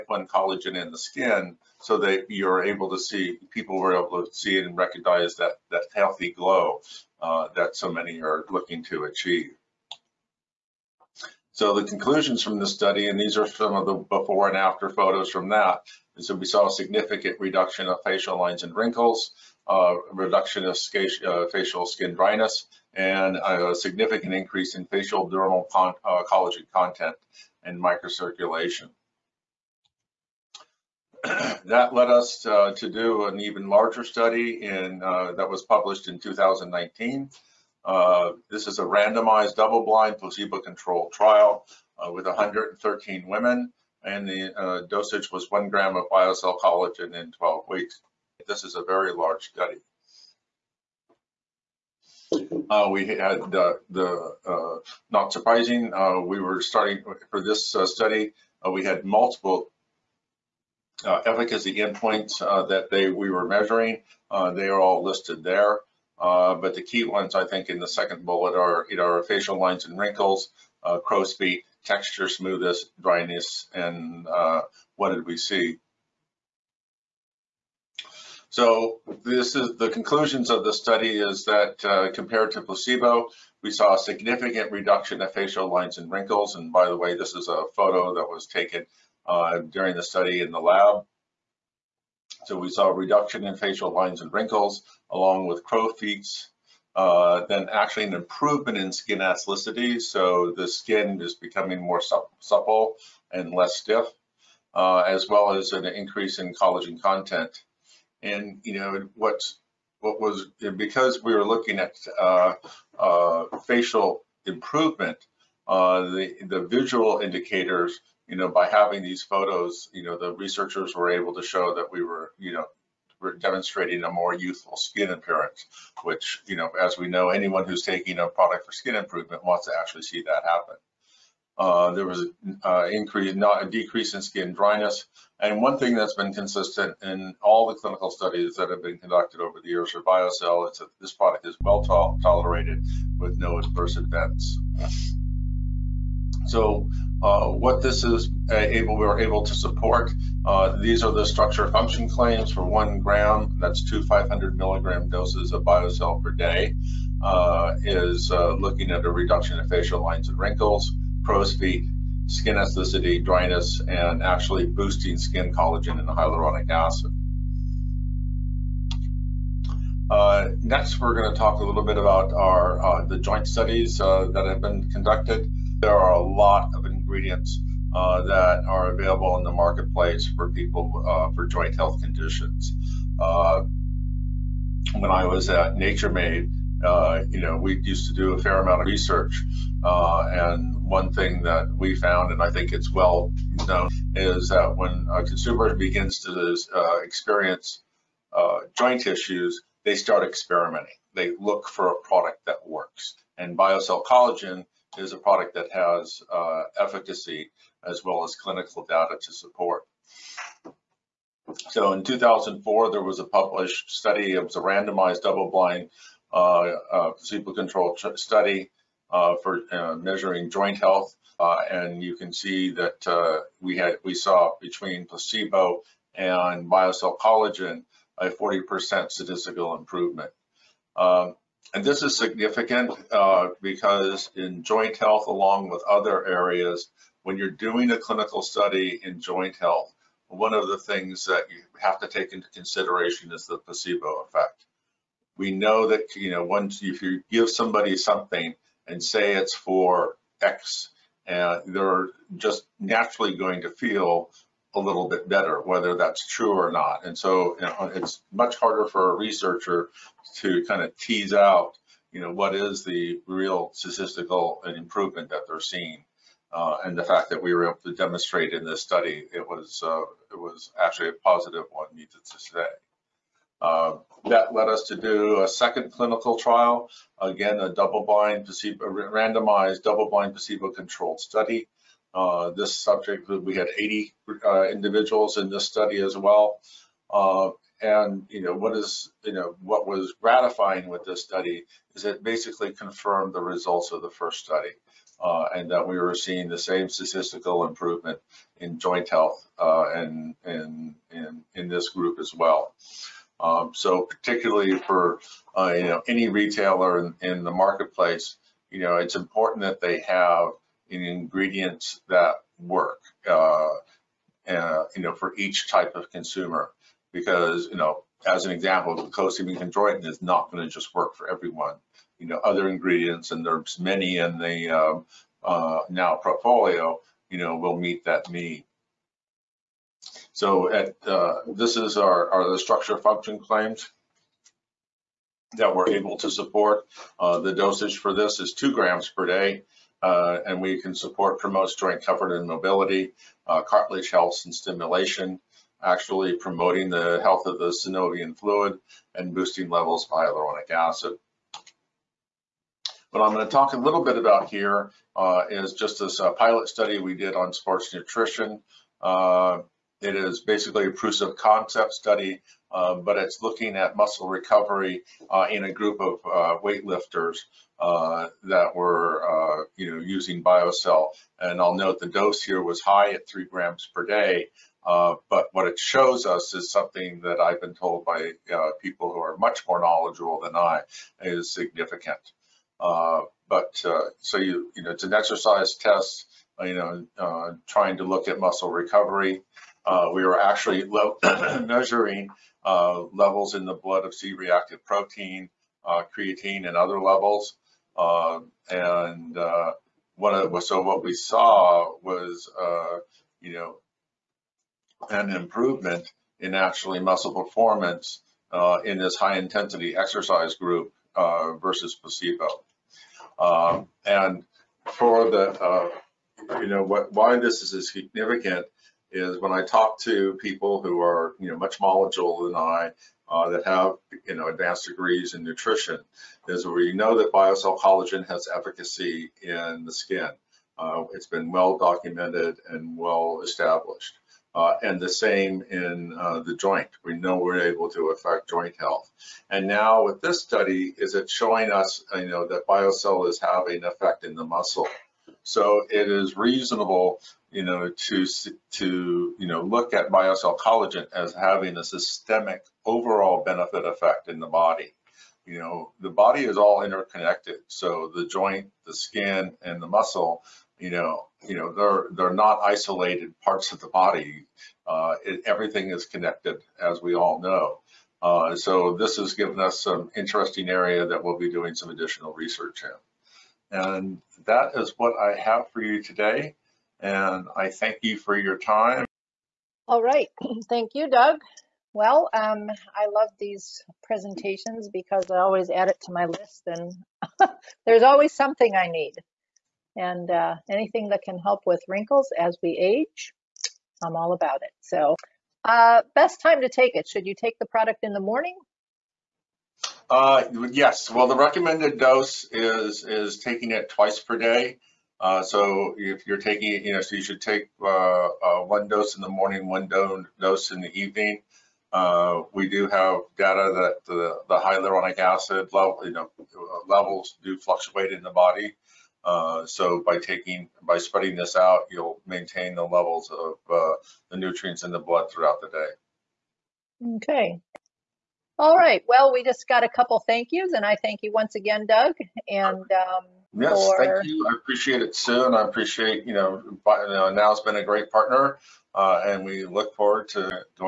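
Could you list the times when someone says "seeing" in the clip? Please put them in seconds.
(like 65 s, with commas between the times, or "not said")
265 s, 296 s.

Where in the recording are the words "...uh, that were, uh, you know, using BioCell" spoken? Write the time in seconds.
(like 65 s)
367 s.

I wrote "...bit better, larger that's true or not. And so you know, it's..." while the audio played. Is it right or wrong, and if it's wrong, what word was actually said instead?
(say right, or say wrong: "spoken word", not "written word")
wrong: "whether", not "larger".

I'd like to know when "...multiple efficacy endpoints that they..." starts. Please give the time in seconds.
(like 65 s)
59 s.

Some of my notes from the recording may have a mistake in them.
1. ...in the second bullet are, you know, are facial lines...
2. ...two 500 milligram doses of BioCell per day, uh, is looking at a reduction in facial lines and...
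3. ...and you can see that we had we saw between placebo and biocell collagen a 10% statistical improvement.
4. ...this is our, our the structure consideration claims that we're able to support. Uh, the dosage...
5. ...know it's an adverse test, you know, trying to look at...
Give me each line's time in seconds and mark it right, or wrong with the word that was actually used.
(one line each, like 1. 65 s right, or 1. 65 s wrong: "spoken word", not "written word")
1. 67 s right
2. 153 s right
3. 221 s wrong: "40", not "10"
4. 331 s wrong: "function", not "consideration"
5. 384 s wrong: "exercise", not "adverse".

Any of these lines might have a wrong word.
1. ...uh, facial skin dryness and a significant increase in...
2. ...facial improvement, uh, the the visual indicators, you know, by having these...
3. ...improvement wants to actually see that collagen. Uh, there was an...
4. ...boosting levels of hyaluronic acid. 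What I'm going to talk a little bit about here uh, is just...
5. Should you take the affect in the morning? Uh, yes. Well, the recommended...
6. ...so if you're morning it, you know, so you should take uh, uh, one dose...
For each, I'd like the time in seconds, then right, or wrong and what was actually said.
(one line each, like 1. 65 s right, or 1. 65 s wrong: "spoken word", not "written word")
1. 21 s right
2. 113 s right
3. 128 s wrong: "happen", not "collagen"
4. 349 s right
5. 497 s wrong: "product", not "affect"
6. 505 s wrong: "taking", not "morning".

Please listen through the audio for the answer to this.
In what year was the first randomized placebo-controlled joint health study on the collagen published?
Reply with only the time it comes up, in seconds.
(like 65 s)
212 s.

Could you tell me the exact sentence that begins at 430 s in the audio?
Uh, it's been well documented and well established.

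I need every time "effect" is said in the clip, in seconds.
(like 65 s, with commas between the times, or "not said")
244 s, 443 s, 453 s.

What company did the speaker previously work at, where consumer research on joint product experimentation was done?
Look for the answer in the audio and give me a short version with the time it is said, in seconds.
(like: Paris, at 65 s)
Nature Made, at 185 s.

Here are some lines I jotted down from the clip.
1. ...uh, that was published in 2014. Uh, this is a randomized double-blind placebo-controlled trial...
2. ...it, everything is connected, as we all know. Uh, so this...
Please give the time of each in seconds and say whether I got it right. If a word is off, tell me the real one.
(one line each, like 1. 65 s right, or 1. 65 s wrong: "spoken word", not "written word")
1. 35 s wrong: "2019", not "2014"
2. 465 s right.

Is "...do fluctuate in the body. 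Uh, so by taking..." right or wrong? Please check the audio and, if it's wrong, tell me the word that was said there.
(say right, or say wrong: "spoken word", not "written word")
right.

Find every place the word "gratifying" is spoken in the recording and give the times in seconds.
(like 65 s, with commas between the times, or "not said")
290 s.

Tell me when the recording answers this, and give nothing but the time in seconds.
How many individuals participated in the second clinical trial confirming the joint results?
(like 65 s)
283 s.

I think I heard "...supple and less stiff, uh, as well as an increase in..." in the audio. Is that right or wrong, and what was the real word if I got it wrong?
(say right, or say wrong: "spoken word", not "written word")
right.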